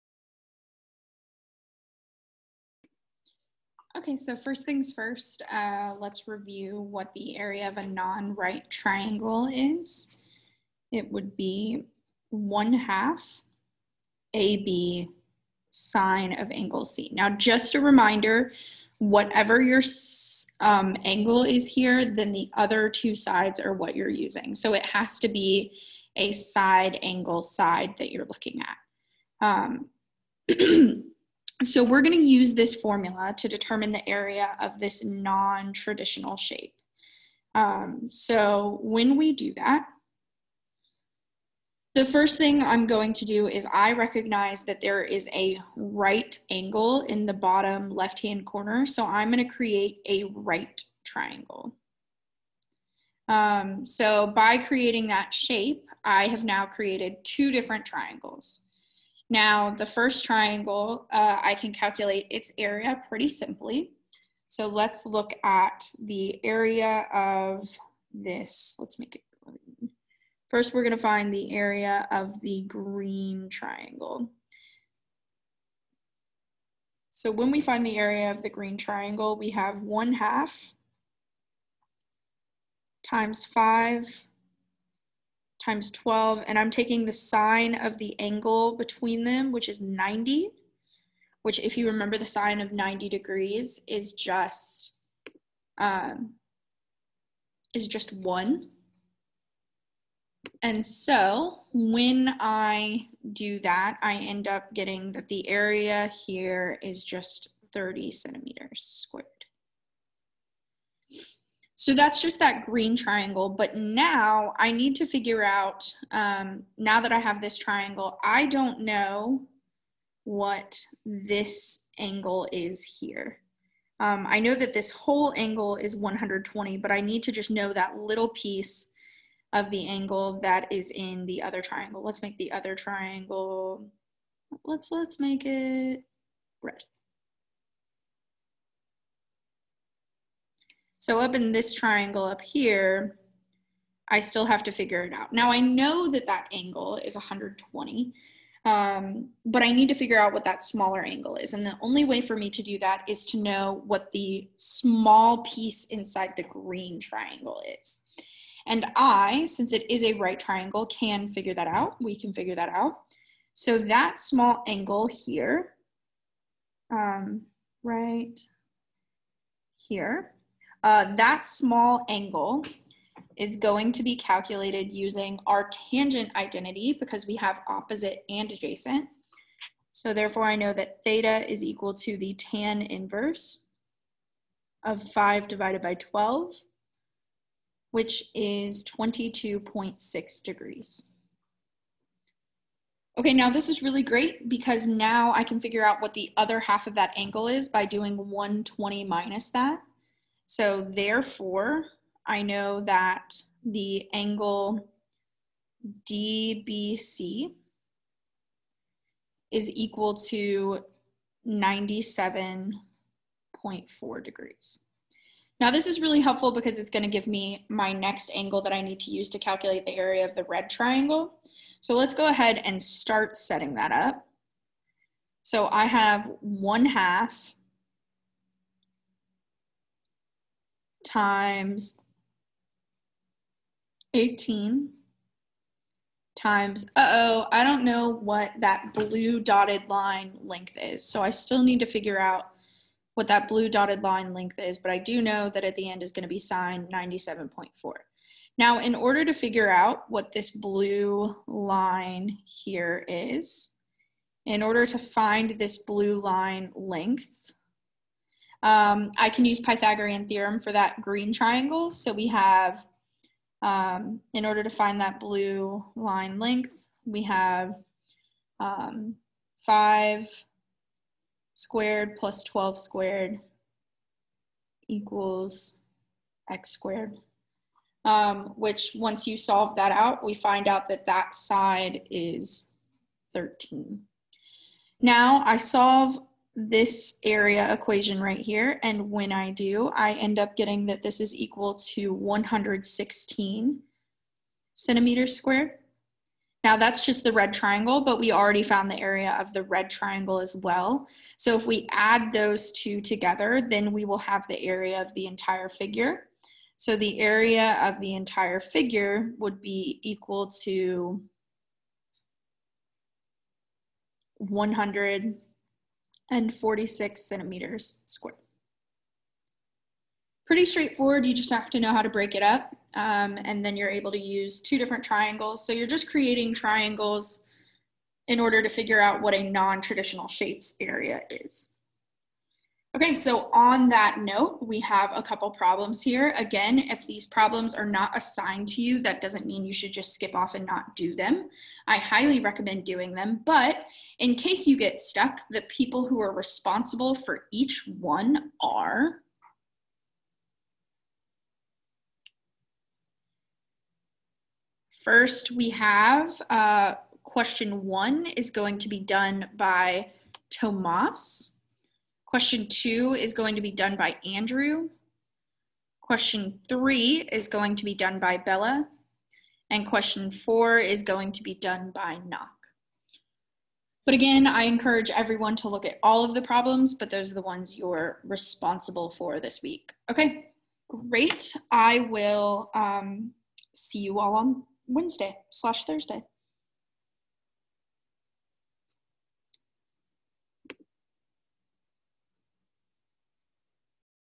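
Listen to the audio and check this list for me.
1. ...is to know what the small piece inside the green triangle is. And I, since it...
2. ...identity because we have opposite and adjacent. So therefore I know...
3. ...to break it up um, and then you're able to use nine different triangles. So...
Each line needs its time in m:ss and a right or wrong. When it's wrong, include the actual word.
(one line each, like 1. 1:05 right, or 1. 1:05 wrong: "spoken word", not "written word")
1. 2:33 right
2. 2:56 right
3. 5:22 wrong: "two", not "nine".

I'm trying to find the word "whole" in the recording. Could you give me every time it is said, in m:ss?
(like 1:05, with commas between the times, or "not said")
2:04.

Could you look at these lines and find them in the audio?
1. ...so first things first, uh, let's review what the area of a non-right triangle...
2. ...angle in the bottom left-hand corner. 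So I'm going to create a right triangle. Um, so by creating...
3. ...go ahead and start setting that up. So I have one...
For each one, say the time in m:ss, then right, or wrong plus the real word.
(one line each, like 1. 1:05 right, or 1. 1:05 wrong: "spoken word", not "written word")
1. 0:04 right
2. 0:46 right
3. 3:42 right.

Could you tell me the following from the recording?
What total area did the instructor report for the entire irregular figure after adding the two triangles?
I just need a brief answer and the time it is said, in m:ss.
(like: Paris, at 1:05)
146 square centimeters, at 5:14.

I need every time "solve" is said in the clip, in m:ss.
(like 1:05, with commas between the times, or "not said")
4:39, 4:45.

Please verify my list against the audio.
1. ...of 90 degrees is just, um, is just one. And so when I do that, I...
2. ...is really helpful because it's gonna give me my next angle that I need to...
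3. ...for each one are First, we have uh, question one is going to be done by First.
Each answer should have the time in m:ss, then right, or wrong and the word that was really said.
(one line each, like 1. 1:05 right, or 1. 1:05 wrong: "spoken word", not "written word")
1. 1:32 right
2. 3:35 right
3. 5:47 wrong: "Tomas", not "First".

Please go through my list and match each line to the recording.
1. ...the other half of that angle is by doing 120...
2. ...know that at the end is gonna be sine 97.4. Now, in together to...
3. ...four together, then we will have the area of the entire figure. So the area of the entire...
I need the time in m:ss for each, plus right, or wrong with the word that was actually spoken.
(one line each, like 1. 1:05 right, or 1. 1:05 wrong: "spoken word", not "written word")
1. 3:16 right
2. 4:05 wrong: "order", not "together"
3. 5:02 wrong: "two", not "four".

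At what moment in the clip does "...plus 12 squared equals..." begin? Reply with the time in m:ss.
4:32.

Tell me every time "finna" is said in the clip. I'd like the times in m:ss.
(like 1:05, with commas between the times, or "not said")
not said.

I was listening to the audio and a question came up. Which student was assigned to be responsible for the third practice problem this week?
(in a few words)
Bella.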